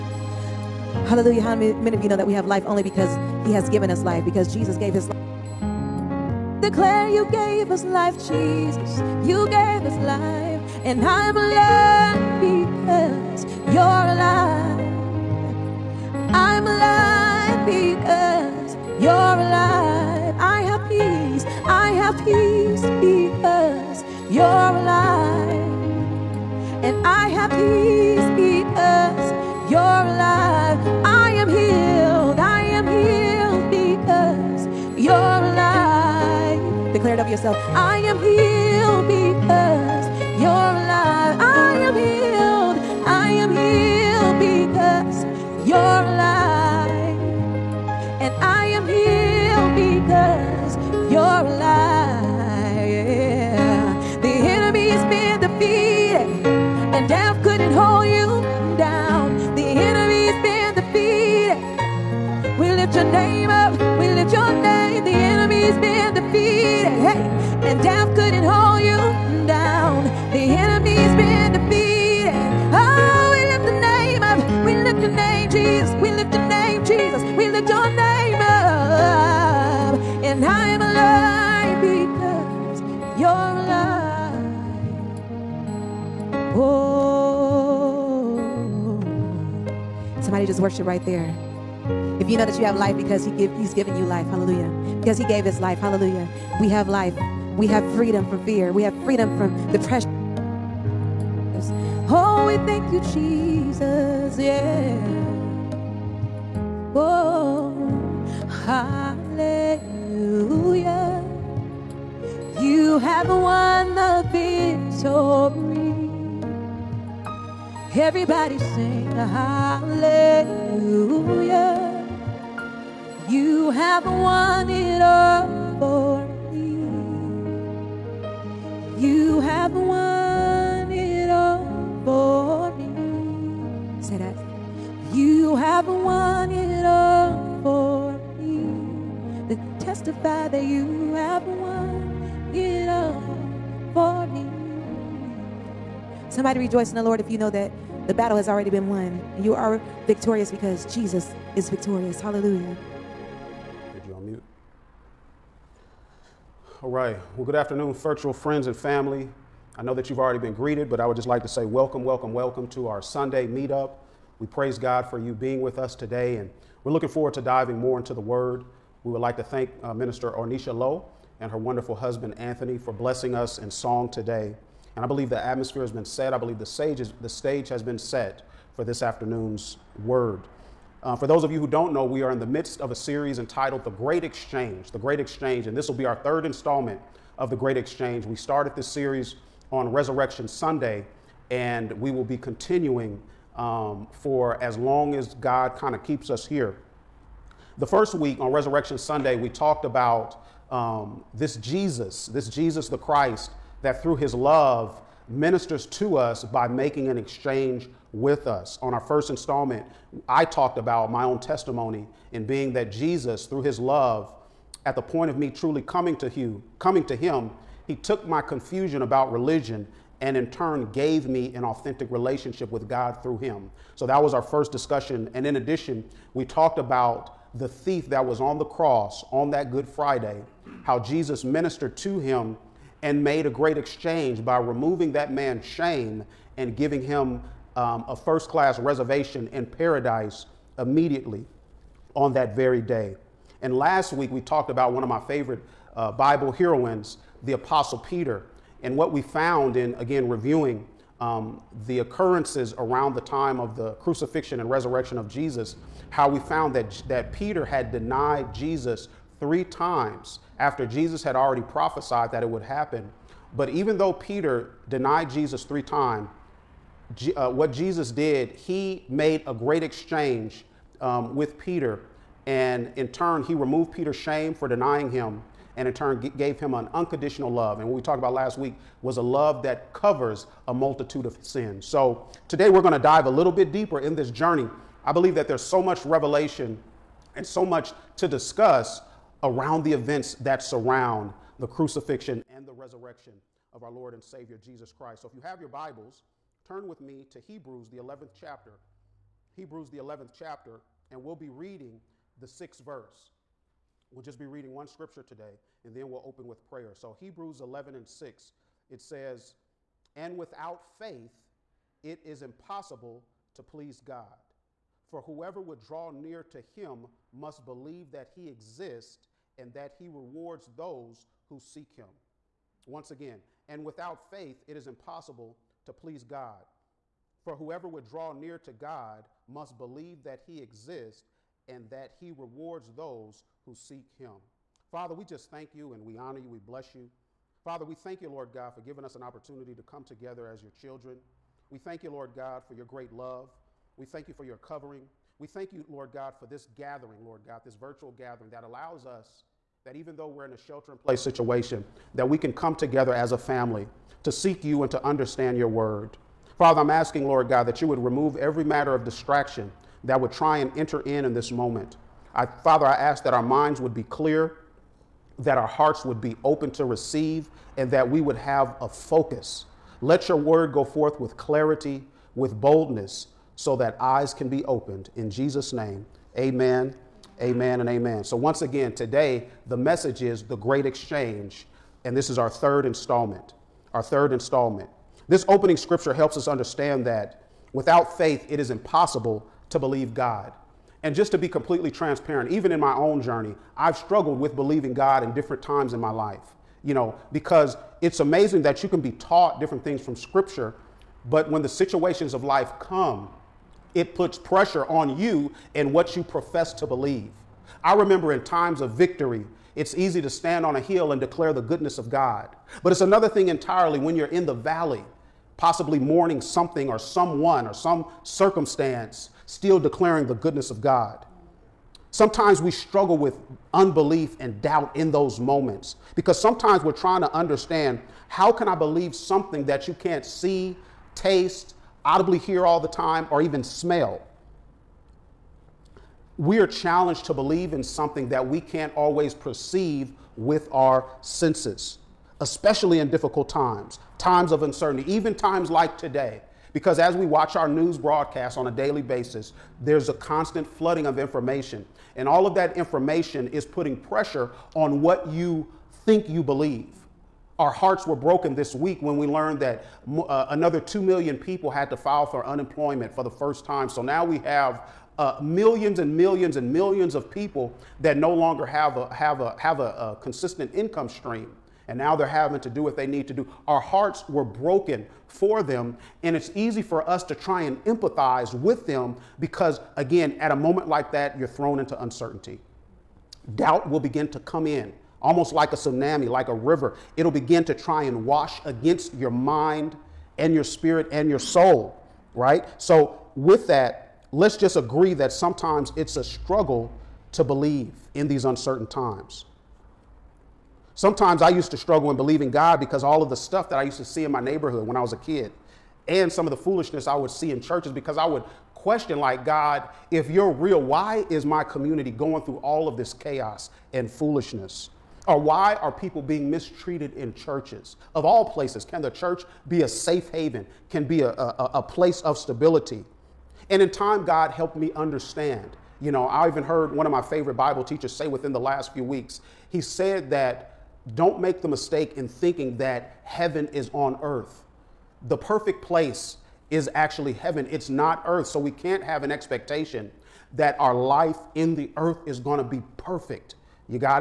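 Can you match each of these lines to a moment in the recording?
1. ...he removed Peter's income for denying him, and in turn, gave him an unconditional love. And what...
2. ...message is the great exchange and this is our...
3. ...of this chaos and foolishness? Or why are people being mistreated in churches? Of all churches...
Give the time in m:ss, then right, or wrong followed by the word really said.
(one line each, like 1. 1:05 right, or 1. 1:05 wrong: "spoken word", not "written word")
1. 4:33 wrong: "shame", not "income"
2. 6:19 right
3. 8:32 wrong: "places", not "churches".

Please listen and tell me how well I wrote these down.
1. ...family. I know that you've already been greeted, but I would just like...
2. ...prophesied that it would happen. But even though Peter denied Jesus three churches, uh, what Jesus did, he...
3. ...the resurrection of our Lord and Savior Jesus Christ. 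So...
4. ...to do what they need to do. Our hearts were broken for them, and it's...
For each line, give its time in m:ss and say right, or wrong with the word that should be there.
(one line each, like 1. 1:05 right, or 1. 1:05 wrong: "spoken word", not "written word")
1. 2:38 right
2. 4:21 wrong: "times", not "churches"
3. 4:52 right
4. 7:52 right.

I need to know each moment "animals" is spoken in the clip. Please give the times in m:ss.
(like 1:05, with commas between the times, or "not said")
not said.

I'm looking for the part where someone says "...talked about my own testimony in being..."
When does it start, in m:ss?
3:30.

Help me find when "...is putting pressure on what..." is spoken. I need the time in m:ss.
7:33.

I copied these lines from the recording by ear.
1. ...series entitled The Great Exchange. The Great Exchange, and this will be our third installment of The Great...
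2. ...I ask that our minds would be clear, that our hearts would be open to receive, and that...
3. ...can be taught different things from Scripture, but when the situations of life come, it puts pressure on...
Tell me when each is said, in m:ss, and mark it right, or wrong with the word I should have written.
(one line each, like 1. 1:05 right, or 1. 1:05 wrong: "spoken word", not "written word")
1. 3:02 right
2. 6:02 right
3. 6:38 right.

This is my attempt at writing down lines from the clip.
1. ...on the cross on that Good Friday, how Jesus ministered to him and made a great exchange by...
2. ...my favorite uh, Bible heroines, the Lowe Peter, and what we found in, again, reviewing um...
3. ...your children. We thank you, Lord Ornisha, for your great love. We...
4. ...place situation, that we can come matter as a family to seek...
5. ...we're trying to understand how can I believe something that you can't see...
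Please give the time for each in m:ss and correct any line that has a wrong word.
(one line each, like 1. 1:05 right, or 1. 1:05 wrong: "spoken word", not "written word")
1. 3:48 right
2. 4:05 wrong: "Apostle", not "Lowe"
3. 5:40 wrong: "God", not "Ornisha"
4. 5:50 wrong: "together", not "matter"
5. 7:06 right.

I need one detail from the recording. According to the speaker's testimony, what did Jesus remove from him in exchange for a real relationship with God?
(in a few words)
Confusion about religion.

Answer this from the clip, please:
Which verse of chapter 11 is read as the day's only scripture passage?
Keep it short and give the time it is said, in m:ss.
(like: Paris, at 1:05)
6, at 5:02.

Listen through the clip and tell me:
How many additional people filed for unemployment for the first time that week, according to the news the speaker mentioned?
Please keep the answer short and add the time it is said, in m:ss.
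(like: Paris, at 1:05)
2 million, at 7:40.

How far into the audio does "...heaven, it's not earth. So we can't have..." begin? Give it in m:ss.
8:57.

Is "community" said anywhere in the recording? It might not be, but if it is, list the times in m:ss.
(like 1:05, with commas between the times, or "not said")
8:31.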